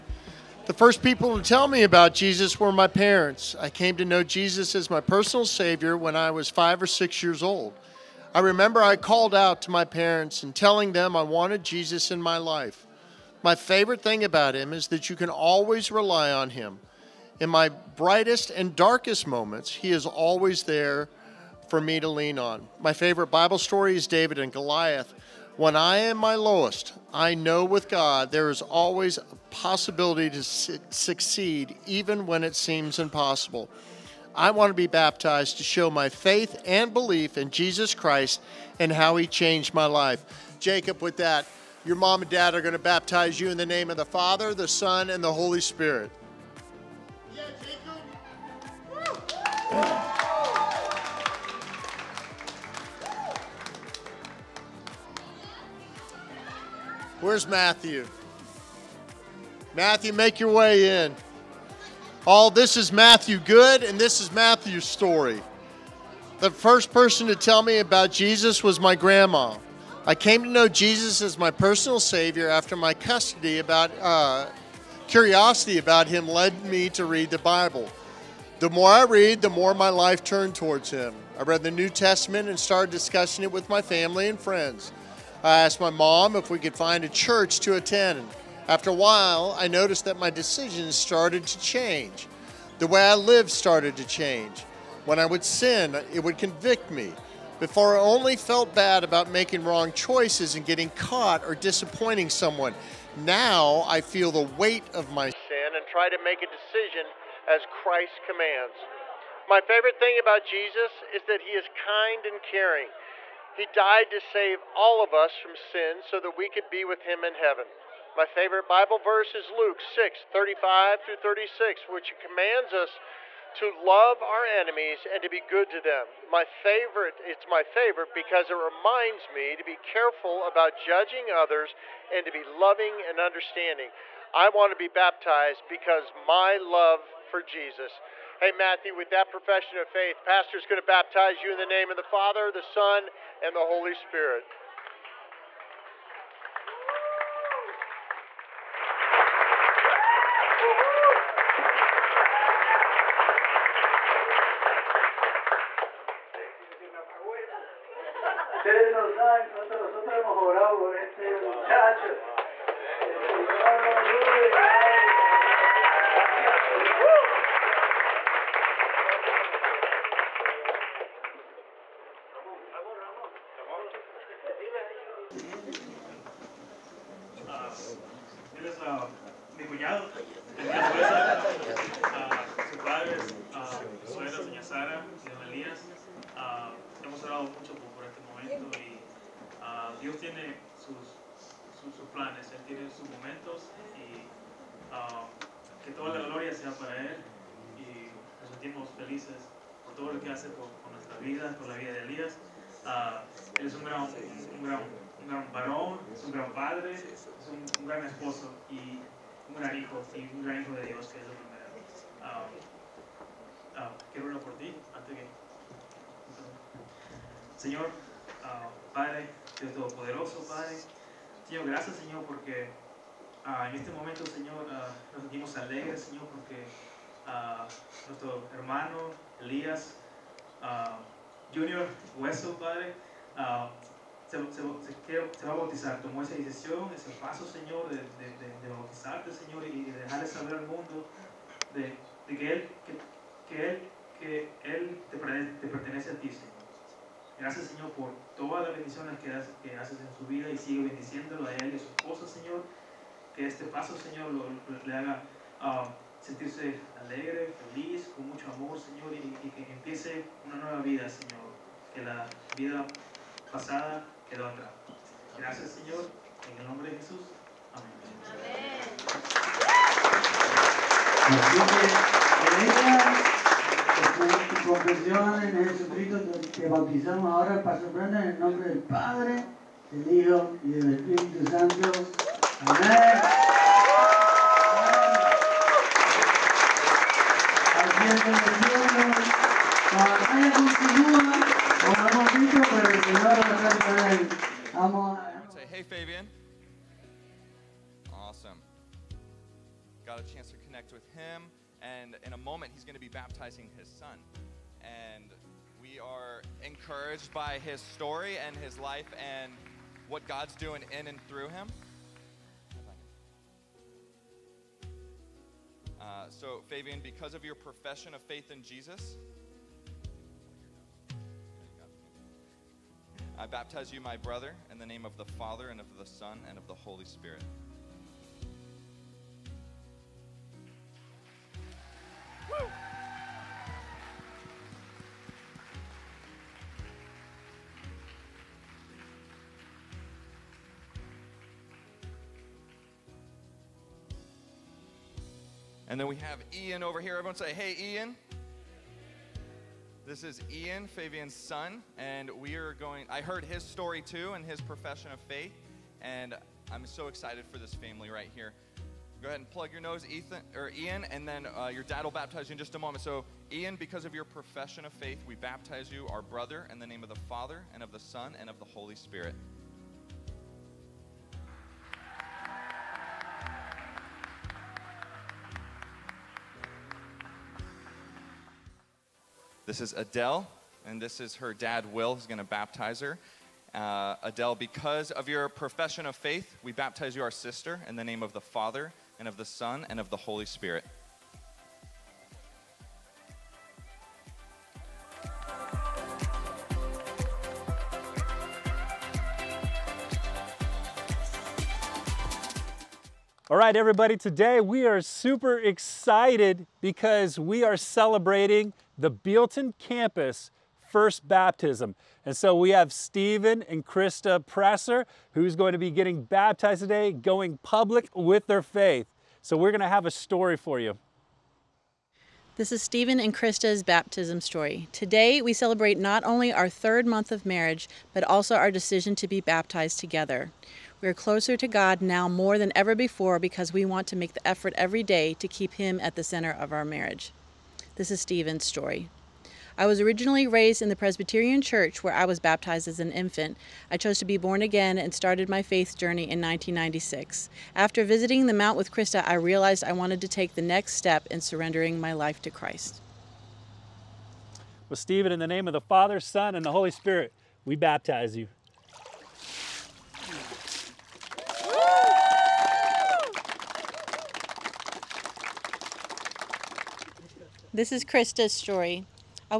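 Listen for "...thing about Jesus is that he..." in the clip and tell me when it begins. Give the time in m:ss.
1:50.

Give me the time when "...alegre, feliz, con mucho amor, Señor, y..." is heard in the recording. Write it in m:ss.
4:17.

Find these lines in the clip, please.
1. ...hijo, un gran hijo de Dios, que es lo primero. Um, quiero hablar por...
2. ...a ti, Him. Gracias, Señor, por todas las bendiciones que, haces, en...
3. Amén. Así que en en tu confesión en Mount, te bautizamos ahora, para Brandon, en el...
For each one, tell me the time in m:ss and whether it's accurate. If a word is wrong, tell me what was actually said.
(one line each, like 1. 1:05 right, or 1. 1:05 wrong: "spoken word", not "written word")
1. 3:29 right
2. 4:06 wrong: "Señor", not "Him"
3. 4:28 wrong: "Jesucristo", not "Mount".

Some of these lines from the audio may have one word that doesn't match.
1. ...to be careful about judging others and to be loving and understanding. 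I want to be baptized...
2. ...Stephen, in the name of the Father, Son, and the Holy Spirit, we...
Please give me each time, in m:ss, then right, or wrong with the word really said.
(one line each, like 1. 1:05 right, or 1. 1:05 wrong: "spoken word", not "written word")
1. 2:09 right
2. 7:34 right.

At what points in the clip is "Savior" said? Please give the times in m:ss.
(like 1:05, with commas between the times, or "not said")
0:05, 1:11.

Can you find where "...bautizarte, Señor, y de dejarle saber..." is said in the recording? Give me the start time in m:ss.
3:58.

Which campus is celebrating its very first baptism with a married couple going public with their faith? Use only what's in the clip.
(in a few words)
Bealton.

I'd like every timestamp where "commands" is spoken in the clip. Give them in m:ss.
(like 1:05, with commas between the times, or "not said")
1:48, 2:02.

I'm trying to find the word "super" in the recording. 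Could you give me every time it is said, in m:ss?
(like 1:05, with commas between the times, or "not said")
6:45.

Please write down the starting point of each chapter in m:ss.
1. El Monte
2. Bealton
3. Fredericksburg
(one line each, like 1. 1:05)
1. 2:27
2. 6:42
3. 4:54.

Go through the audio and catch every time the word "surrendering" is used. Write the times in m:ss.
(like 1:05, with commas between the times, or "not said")
7:31.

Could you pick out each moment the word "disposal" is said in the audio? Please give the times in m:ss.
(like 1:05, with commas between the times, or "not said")
not said.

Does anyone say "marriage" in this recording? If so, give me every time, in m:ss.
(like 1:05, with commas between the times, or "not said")
7:07, 7:16.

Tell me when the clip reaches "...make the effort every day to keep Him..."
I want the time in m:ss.
7:14.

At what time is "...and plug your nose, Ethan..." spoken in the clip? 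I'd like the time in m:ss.
5:59.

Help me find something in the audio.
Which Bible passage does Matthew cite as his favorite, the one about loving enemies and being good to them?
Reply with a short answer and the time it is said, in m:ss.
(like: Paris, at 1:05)
Luke 6:35-36, at 1:59.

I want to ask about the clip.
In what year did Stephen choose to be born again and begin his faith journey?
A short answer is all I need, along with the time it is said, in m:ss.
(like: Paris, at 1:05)
1996, at 7:26.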